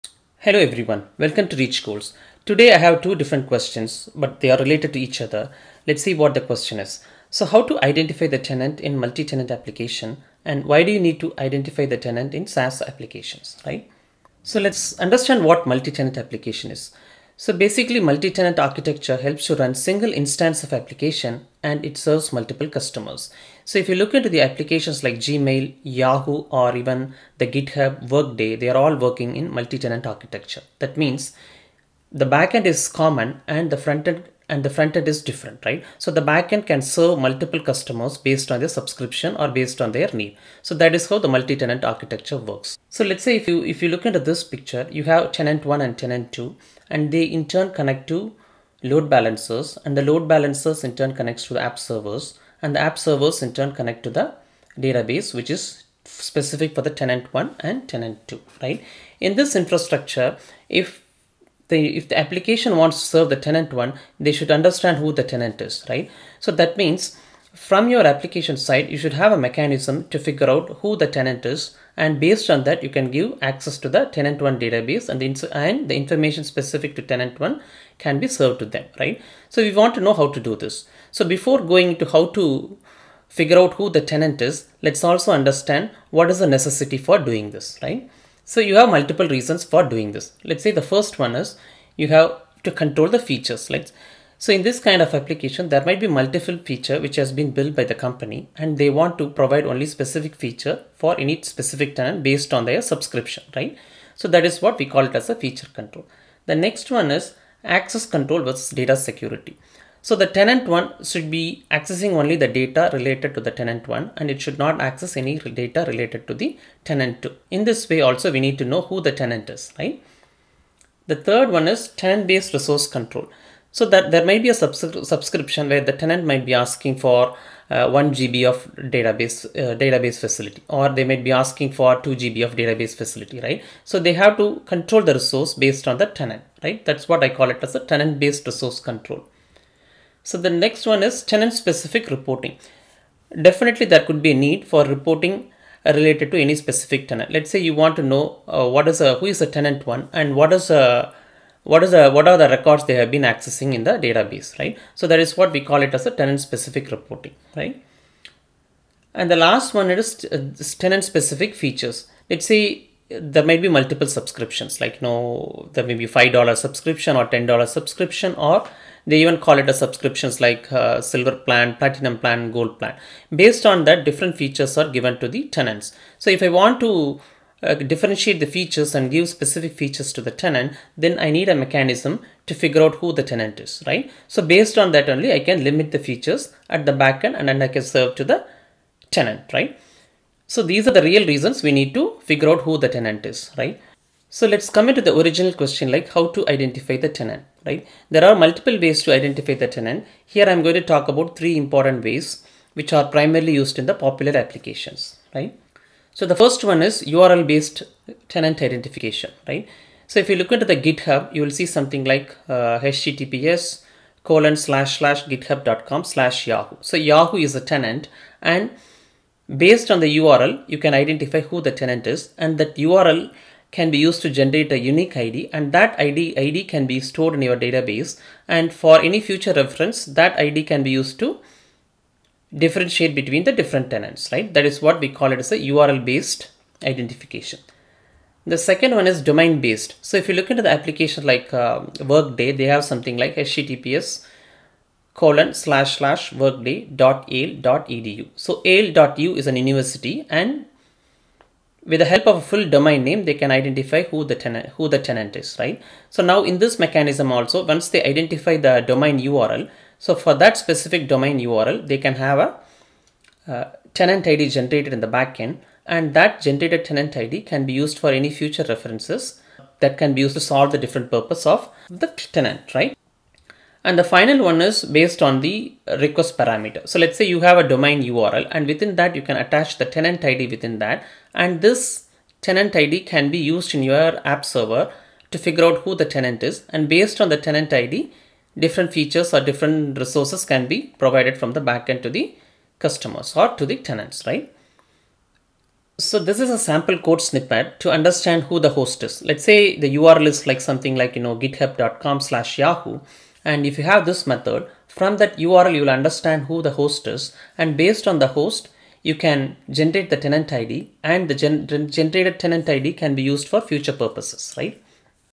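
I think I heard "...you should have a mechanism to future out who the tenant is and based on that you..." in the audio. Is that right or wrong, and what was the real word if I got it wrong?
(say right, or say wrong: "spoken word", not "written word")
wrong: "figure", not "future".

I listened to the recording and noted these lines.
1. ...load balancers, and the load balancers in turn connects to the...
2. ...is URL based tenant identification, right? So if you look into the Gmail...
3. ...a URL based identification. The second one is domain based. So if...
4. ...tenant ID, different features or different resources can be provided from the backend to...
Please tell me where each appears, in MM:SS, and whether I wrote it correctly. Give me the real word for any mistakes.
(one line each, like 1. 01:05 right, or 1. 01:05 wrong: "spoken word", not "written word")
1. 00:48 right
2. 03:26 wrong: "GitHub", not "Gmail"
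3. 03:55 right
4. 04:47 right.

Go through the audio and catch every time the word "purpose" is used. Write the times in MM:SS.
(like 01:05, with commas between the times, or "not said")
04:31, 05:13.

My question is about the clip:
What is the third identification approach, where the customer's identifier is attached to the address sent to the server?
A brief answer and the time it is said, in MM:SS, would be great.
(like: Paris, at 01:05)
request parameter, at 04:35.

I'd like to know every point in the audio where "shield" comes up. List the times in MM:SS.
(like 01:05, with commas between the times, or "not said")
not said.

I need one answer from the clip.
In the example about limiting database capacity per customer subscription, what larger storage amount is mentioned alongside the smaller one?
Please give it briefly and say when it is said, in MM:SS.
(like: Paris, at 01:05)
2 GB, at 02:12.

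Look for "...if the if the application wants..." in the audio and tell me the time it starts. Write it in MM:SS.
01:00.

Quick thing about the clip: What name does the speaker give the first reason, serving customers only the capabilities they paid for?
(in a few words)
feature control.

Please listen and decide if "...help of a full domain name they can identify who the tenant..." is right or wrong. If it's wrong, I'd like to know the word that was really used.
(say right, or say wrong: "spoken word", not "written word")
right.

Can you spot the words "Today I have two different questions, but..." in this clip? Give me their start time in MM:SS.
00:02.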